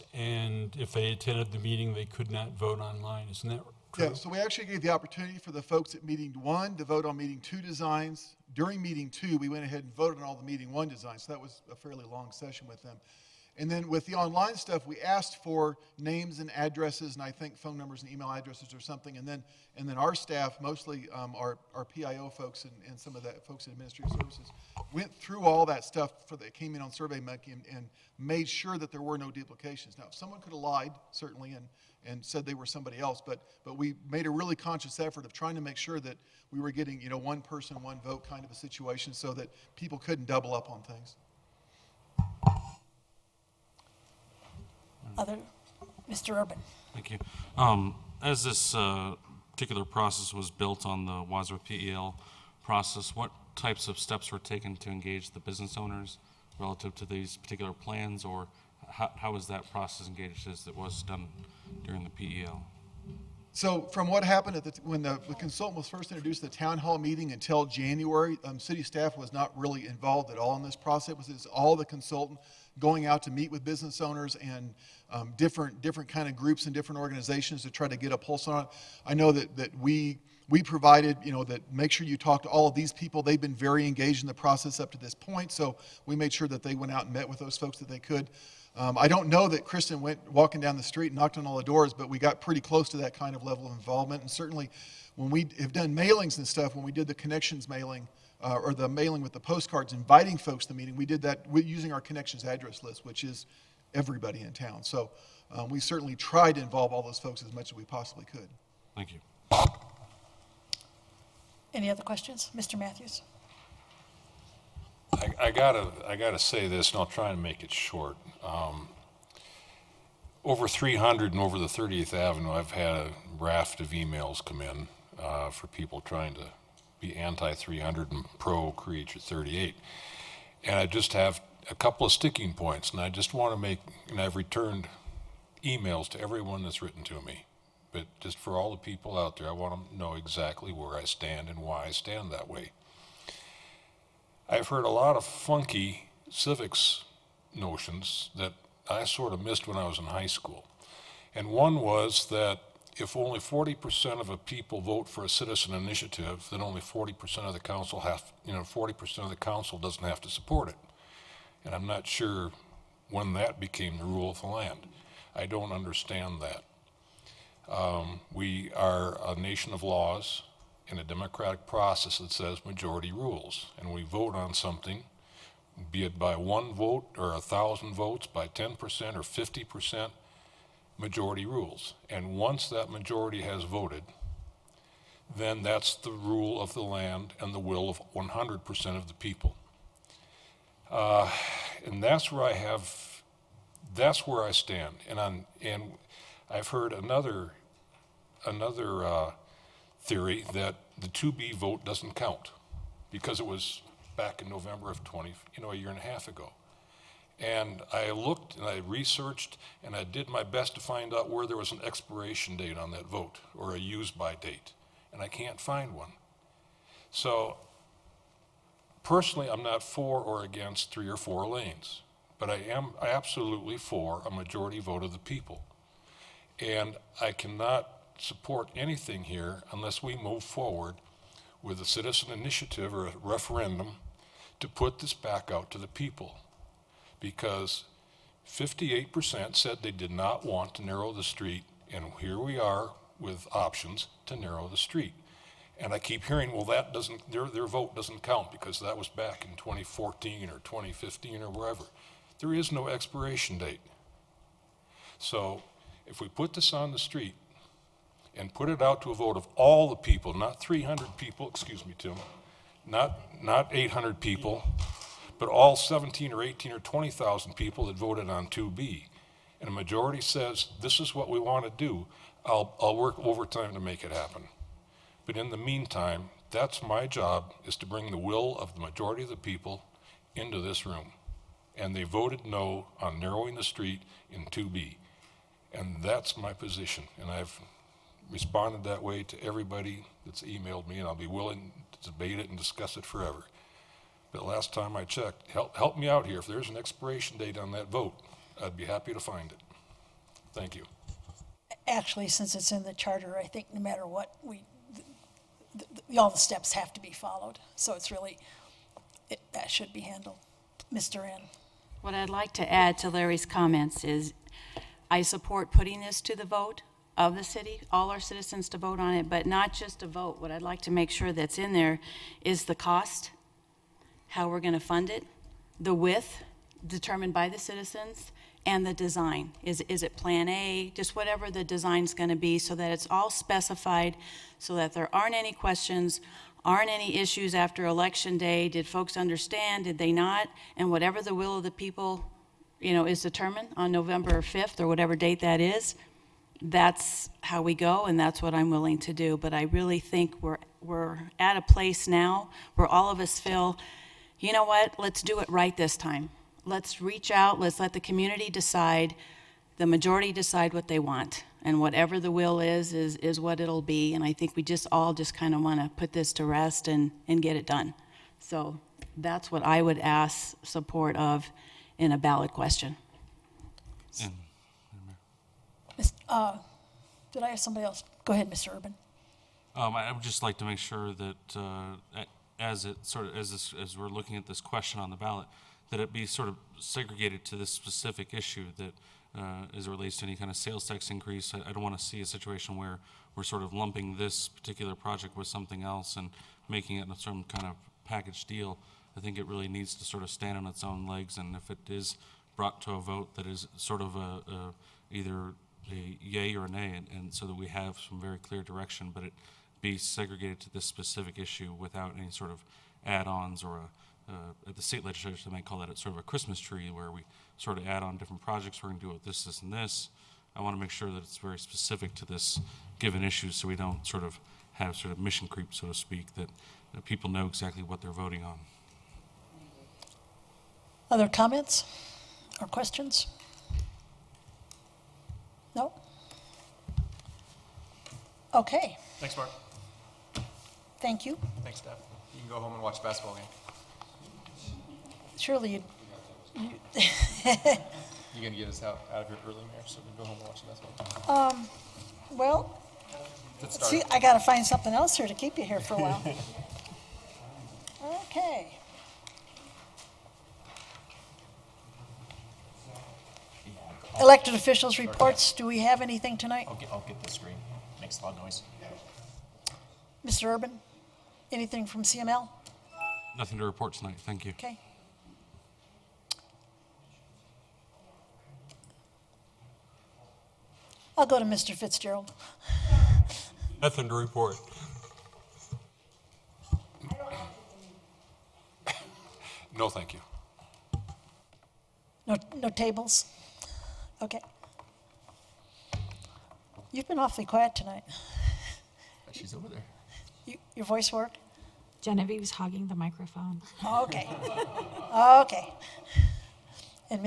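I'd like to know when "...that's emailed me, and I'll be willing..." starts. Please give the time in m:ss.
4:50.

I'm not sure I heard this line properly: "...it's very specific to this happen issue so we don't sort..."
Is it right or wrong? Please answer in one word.
wrong.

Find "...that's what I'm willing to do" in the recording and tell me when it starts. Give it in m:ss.
5:48.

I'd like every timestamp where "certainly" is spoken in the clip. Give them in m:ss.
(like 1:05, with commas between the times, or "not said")
0:31, 1:34, 1:45.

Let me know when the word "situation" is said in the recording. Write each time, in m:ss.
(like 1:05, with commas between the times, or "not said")
0:38, 6:32.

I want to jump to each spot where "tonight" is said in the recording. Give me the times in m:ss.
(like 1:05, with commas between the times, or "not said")
7:46, 7:53, 8:17.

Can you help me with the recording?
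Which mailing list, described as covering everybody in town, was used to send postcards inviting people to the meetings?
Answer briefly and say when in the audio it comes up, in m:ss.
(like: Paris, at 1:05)
connections address list, at 1:42.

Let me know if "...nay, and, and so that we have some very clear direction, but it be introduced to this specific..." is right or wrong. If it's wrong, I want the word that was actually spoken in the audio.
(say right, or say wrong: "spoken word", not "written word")
wrong: "segregated", not "introduced".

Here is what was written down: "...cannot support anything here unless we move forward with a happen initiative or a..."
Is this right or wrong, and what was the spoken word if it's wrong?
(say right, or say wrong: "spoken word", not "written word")
wrong: "citizen", not "happen".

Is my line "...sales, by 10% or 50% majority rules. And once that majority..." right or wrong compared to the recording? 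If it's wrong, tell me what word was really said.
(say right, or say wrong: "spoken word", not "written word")
wrong: "votes", not "sales".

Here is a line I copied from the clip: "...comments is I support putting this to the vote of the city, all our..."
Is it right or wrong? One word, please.
right.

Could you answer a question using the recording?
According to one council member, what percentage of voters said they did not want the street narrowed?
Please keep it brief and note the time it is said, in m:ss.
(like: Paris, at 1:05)
58%, at 3:58.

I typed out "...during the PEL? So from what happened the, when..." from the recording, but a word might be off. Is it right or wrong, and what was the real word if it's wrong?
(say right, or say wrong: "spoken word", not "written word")
right.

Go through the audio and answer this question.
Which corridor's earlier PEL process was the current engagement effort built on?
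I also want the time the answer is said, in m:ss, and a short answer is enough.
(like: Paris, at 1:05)
Wadsworth, at 0:51.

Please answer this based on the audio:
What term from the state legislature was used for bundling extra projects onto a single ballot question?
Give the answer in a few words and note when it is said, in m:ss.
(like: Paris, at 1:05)
Christmas tree, at 6:56.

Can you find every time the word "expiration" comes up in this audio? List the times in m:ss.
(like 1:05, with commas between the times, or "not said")
3:31, 4:12, 4:56.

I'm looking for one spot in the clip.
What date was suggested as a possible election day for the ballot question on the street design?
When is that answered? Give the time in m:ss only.
5:43.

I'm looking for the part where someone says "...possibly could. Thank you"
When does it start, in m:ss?
1:47.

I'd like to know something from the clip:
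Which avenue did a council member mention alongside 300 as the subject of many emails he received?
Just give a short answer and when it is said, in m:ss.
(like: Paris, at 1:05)
30th Avenue, at 2:01.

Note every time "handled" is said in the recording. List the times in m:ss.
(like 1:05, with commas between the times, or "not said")
5:10.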